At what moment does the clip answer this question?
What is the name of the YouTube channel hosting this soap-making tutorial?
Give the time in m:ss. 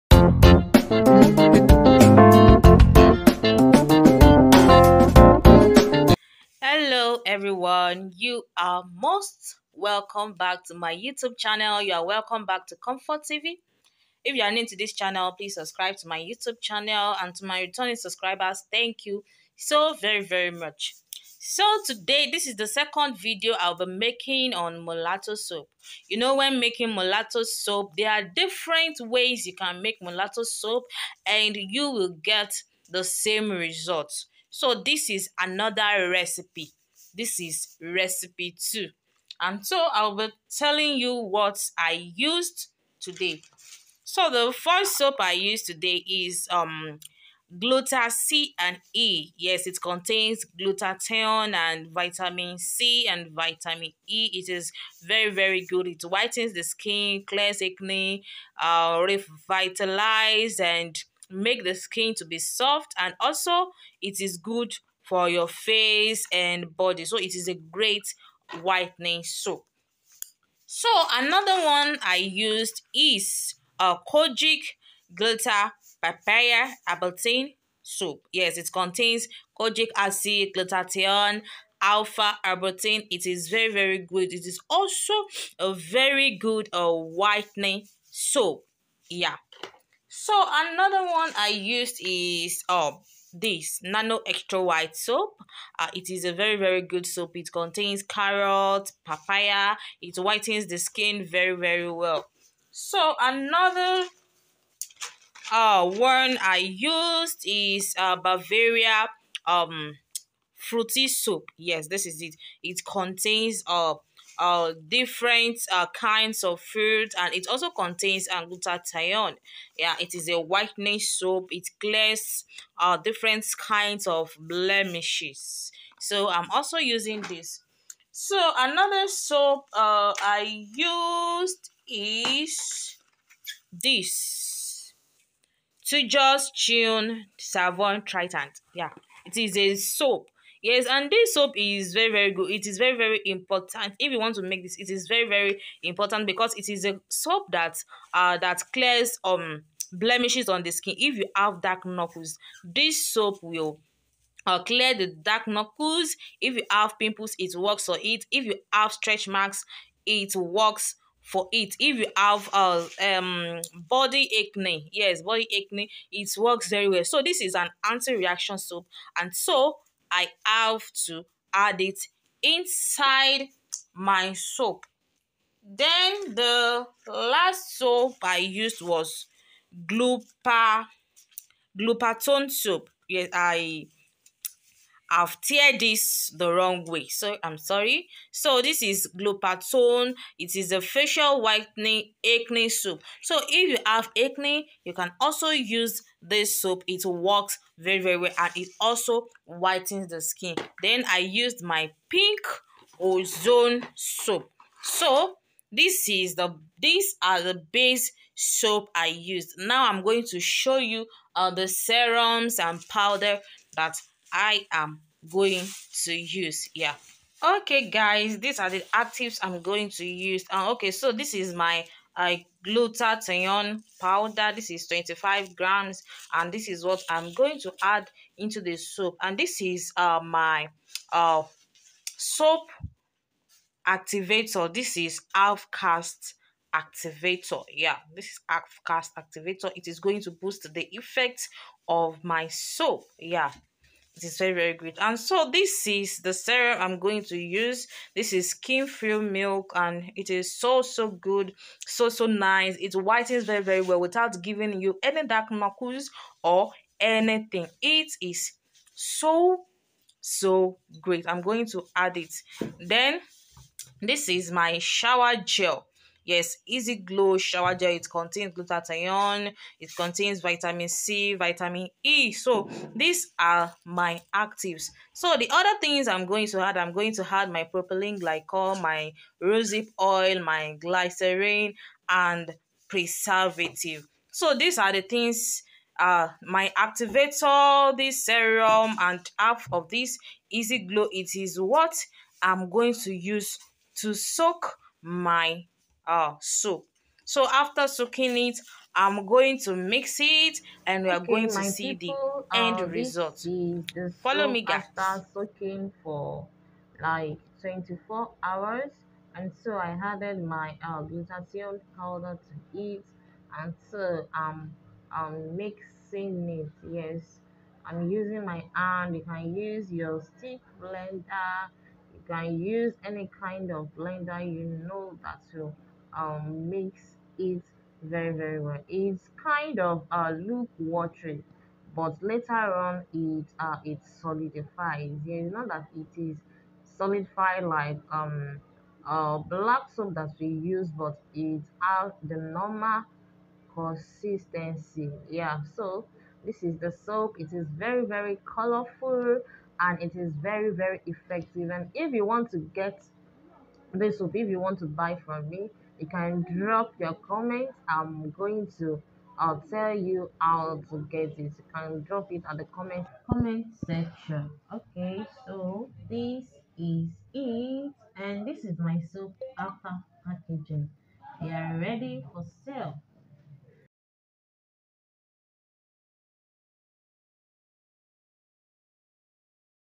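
0:12.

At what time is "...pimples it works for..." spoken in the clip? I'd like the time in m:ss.
2:36.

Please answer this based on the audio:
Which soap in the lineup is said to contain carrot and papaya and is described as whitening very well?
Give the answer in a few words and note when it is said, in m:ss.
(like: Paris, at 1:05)
Nano Extra White, at 1:33.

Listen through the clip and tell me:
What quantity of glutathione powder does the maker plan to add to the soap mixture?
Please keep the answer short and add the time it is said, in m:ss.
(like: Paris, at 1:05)
25 grams, at 3:44.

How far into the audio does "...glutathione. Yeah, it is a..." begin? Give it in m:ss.
1:58.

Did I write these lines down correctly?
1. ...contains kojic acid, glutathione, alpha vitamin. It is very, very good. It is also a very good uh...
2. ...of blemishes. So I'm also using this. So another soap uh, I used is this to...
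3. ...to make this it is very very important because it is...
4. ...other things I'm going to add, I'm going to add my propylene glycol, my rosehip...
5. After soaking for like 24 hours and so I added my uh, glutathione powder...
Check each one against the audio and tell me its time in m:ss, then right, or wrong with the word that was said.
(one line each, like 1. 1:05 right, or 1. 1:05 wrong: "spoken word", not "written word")
1. 1:18 wrong: "arbutin", not "vitamin"
2. 2:04 right
3. 2:24 right
4. 4:35 right
5. 5:04 right.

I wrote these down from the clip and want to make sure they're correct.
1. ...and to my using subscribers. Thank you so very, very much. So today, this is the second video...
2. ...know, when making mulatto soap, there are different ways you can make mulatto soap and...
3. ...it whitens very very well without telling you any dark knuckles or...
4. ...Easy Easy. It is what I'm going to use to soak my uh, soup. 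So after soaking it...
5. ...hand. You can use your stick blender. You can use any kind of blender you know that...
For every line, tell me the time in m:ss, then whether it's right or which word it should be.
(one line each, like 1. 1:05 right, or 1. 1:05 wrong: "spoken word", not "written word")
1. 0:17 wrong: "returning", not "using"
2. 0:26 right
3. 4:12 wrong: "giving", not "telling"
4. 4:50 wrong: "Glow", not "Easy"
5. 5:18 right.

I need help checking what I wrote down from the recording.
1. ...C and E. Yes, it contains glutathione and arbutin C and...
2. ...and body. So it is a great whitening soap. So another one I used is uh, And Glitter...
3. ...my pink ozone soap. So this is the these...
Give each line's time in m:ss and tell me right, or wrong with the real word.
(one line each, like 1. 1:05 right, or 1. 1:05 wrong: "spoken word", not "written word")
1. 0:48 wrong: "vitamin", not "arbutin"
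2. 1:06 wrong: "Kojic", not "And"
3. 3:21 right.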